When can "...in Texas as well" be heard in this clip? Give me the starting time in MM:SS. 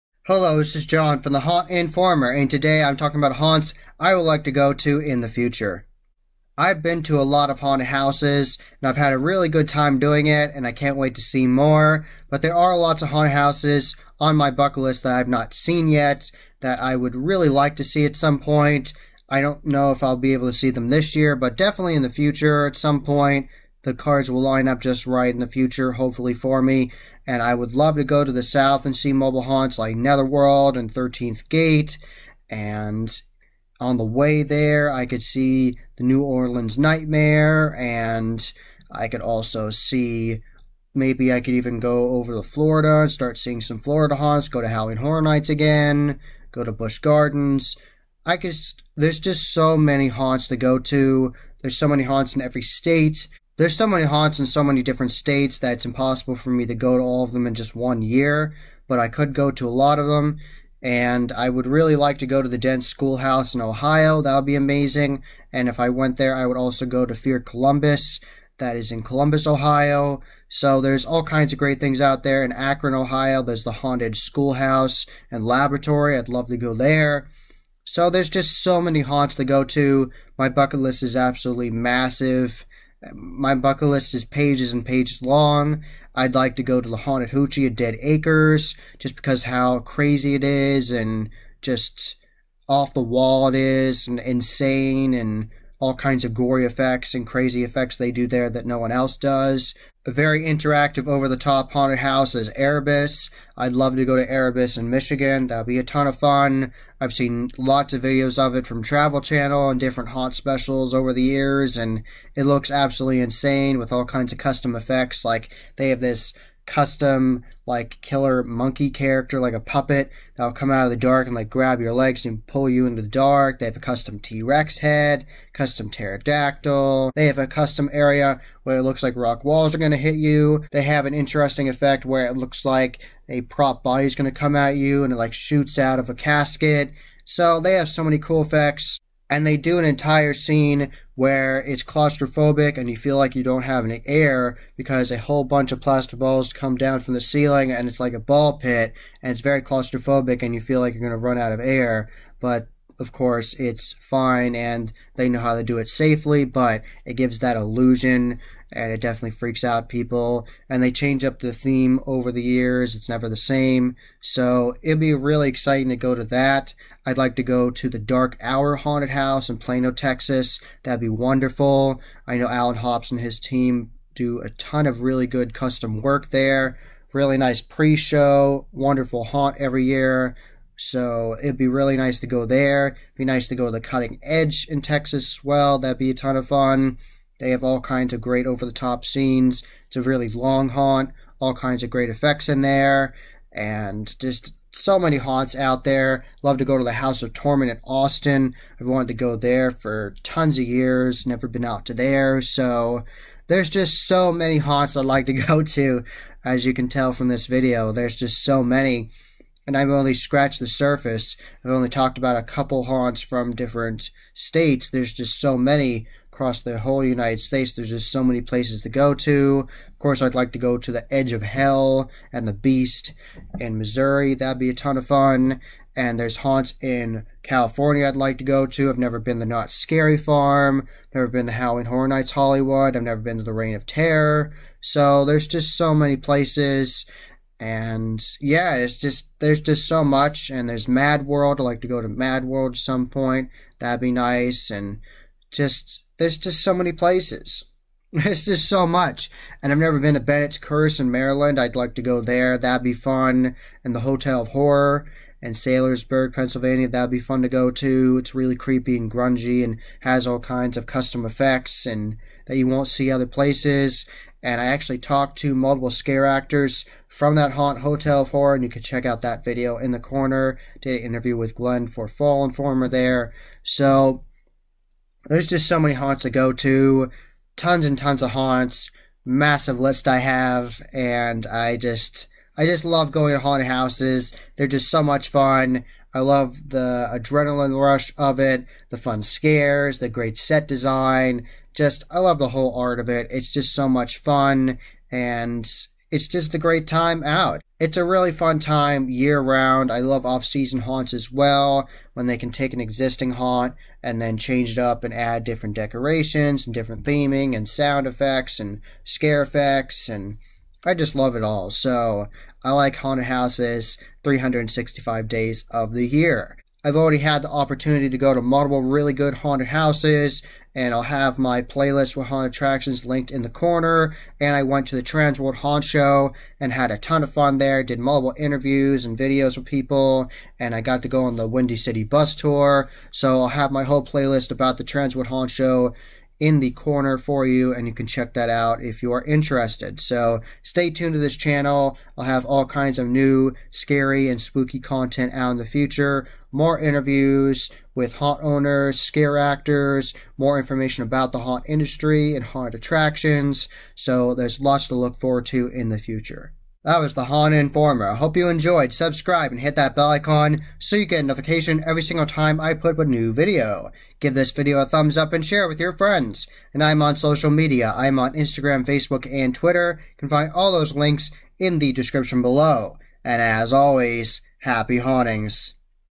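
03:04.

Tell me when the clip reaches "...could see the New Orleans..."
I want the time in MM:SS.
00:35.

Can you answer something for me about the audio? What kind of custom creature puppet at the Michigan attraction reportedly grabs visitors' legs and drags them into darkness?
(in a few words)
Killer monkey.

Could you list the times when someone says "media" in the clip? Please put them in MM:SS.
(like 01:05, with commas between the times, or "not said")
06:07.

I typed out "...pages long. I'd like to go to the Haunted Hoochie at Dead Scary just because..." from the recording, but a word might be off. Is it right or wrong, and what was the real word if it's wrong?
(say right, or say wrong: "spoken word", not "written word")
wrong: "Acres", not "Scary".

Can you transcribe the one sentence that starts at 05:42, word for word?
I'll have all kinds of new scary and spooky content out in the future.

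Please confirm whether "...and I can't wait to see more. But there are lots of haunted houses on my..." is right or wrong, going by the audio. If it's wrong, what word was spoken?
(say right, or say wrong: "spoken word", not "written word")
right.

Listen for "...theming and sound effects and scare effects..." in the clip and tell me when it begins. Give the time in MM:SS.
05:07.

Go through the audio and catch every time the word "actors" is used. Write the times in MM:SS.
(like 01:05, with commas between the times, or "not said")
04:26, 05:49.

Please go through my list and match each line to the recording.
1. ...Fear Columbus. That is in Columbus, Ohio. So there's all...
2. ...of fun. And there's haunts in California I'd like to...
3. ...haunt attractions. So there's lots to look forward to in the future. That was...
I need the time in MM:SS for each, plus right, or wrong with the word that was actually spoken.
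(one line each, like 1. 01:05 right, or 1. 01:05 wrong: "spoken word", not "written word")
1. 01:07 right
2. 03:44 right
3. 05:52 right.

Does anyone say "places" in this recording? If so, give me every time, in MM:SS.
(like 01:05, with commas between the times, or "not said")
03:38, 03:56, 04:06, 04:23.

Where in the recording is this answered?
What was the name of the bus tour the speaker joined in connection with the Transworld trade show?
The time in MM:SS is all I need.
05:31.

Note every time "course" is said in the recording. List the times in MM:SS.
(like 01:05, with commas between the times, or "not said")
02:33, 03:39.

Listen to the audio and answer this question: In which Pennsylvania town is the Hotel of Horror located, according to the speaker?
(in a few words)
Saylorsburg.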